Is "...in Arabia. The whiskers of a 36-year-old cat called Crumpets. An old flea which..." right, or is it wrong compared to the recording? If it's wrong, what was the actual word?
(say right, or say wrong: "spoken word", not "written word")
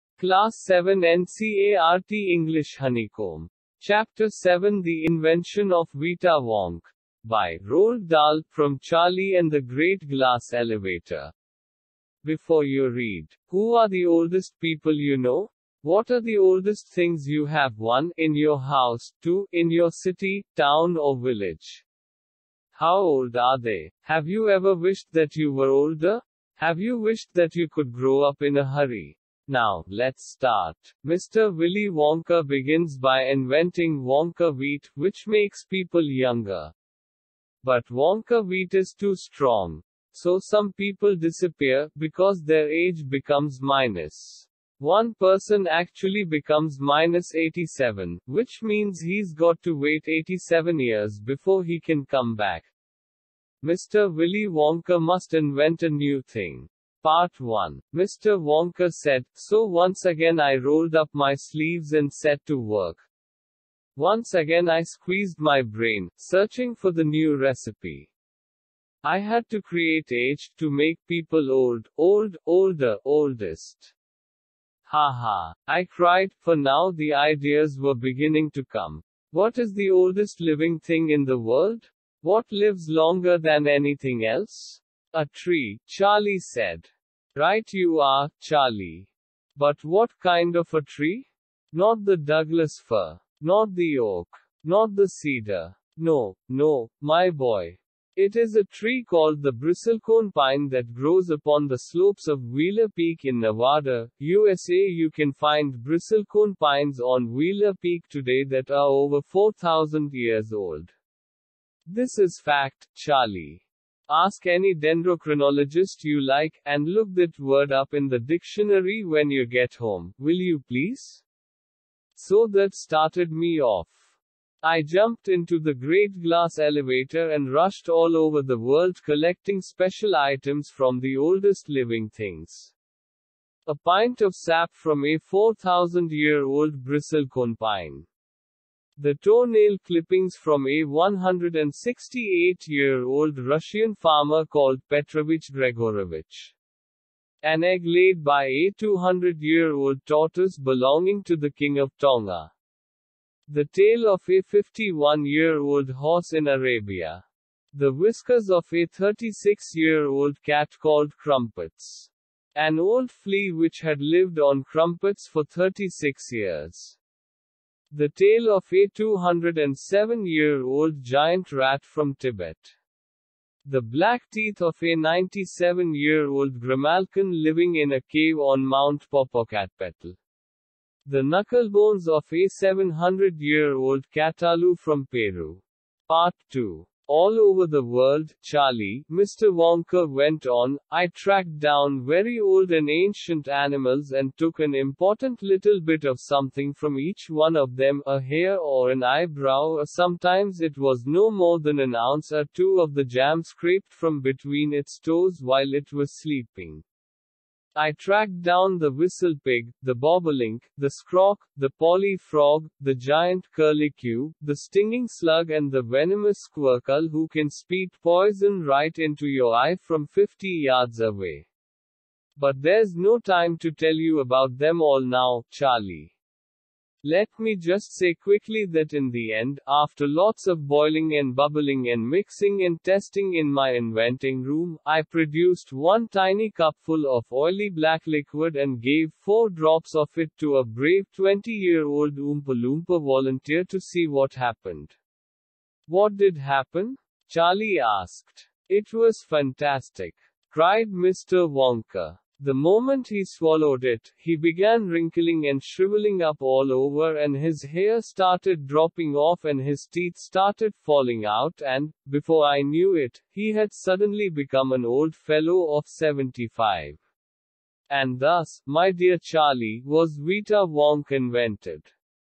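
right.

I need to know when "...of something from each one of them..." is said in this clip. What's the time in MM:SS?
03:16.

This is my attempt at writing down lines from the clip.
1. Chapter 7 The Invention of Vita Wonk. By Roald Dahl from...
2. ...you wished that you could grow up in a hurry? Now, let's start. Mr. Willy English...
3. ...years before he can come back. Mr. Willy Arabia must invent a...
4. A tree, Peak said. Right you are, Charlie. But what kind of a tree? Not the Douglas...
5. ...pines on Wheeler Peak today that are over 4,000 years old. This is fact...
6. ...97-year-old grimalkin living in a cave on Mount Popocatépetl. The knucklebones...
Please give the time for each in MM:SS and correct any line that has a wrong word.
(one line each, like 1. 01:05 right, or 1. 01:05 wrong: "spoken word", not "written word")
1. 00:03 right
2. 00:26 wrong: "Wonka", not "English"
3. 00:50 wrong: "Wonka", not "Arabia"
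4. 01:25 wrong: "Charlie", not "Peak"
5. 01:46 right
6. 02:54 right.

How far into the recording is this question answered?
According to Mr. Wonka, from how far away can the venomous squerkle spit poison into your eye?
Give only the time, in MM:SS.
03:40.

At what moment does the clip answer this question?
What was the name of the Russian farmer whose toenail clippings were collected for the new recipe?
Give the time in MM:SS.
02:24.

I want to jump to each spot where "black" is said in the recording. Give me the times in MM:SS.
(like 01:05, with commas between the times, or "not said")
02:53, 03:57.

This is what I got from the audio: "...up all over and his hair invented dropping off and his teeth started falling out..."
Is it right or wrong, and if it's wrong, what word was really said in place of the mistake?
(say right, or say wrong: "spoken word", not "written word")
wrong: "started", not "invented".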